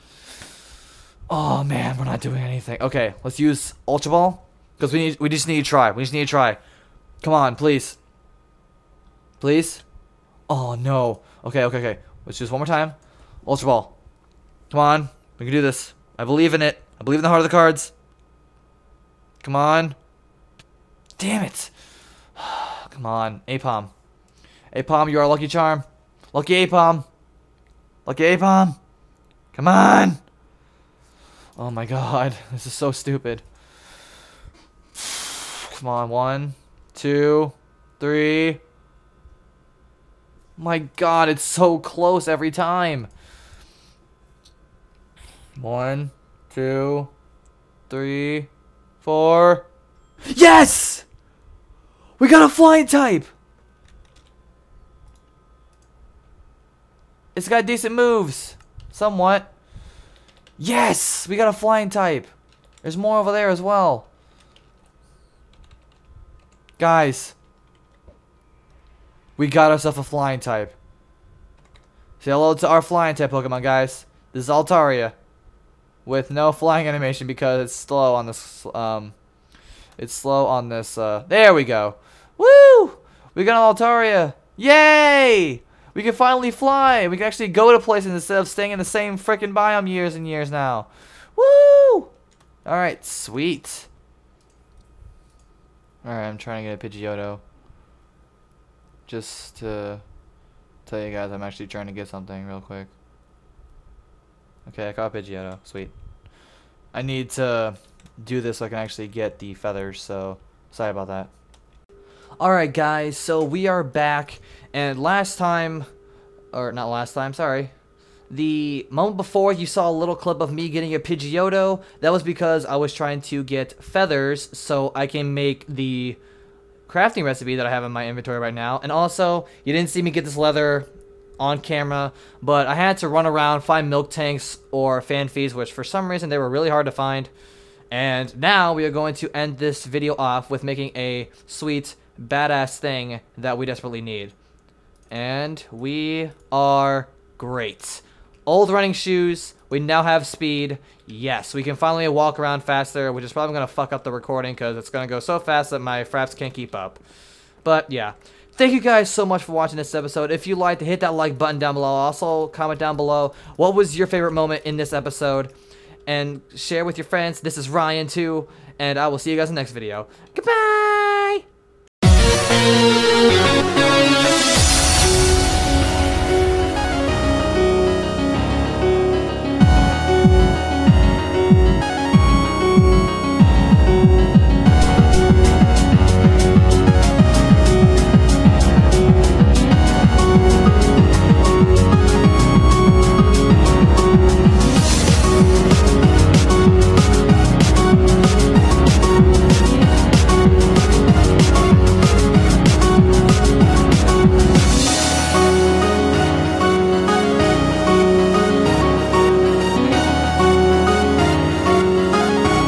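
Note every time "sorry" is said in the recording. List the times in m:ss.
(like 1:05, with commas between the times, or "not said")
1:50, 1:57.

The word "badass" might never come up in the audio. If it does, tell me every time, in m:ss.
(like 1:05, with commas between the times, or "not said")
2:22.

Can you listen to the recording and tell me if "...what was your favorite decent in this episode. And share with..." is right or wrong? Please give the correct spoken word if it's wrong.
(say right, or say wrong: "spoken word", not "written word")
wrong: "moment", not "decent".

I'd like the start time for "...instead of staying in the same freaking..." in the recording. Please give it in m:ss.
1:28.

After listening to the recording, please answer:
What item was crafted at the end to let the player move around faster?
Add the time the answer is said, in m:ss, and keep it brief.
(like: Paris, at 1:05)
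Old running shoes, at 2:28.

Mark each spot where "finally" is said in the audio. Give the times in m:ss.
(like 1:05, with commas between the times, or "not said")
1:26, 2:31.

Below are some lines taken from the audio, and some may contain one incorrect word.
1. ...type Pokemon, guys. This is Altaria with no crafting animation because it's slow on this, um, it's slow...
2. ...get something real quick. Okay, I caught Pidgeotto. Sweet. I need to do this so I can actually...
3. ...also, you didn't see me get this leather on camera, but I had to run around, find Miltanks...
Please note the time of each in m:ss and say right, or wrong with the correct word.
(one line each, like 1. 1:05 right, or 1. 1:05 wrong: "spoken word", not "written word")
1. 1:13 wrong: "flying", not "crafting"
2. 1:41 right
3. 2:08 right.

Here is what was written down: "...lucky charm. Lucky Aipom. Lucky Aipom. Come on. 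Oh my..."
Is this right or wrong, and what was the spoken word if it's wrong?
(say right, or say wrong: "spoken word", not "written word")
right.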